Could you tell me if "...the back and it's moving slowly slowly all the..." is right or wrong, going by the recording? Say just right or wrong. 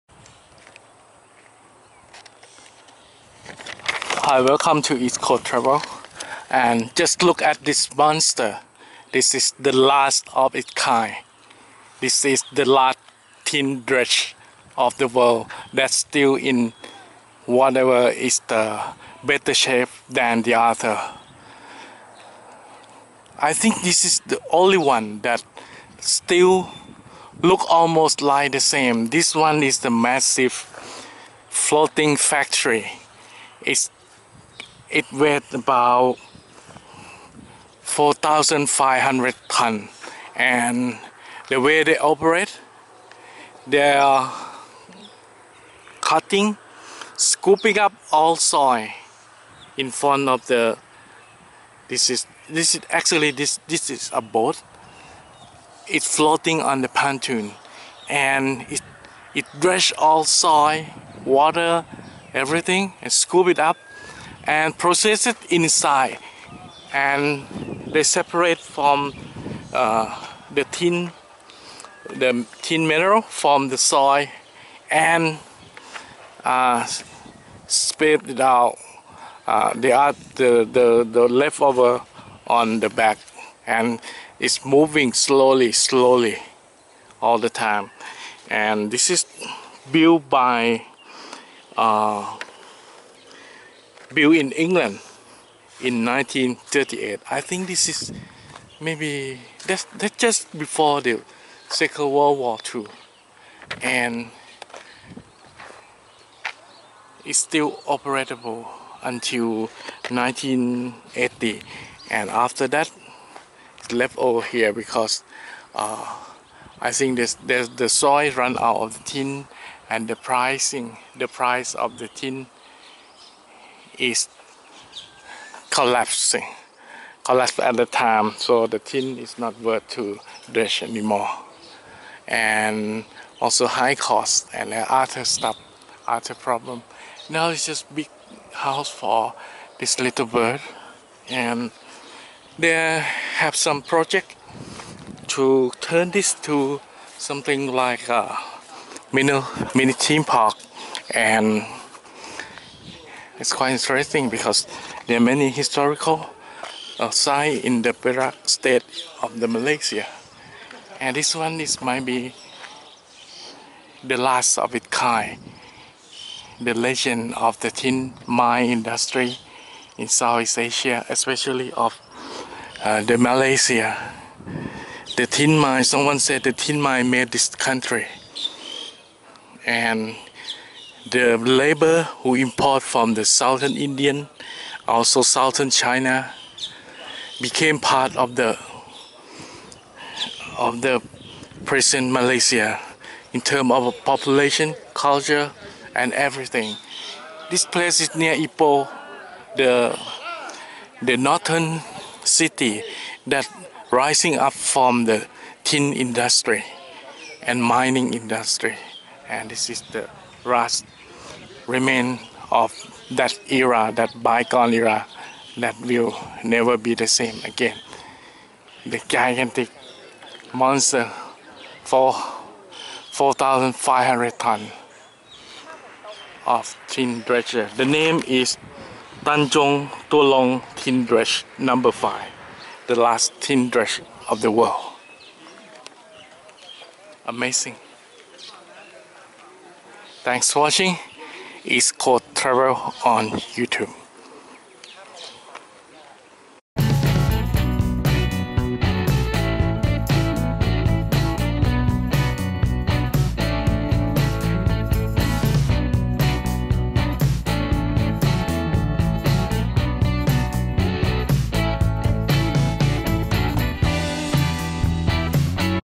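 right.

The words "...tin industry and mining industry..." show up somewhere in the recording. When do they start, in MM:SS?
03:25.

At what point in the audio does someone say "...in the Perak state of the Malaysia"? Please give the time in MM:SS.
02:37.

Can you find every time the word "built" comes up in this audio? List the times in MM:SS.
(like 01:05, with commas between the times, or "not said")
01:29, 01:34.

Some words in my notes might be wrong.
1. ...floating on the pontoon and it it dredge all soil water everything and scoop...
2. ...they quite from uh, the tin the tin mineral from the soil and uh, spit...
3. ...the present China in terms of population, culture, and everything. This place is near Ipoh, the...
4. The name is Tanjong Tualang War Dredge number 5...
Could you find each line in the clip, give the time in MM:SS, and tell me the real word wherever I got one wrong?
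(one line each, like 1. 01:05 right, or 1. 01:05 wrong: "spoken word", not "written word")
1. 00:56 right
2. 01:07 wrong: "separate", not "quite"
3. 03:10 wrong: "Malaysia", not "China"
4. 03:47 wrong: "Tin", not "War".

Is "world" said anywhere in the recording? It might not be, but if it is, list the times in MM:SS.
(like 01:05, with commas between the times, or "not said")
00:15, 01:42, 03:54.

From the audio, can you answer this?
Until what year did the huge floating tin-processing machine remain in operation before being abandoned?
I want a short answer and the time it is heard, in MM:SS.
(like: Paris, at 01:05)
1980, at 01:50.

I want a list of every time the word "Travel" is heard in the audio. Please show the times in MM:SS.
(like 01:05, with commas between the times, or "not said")
00:05, 04:02.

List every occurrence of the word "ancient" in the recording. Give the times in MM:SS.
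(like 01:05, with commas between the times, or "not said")
not said.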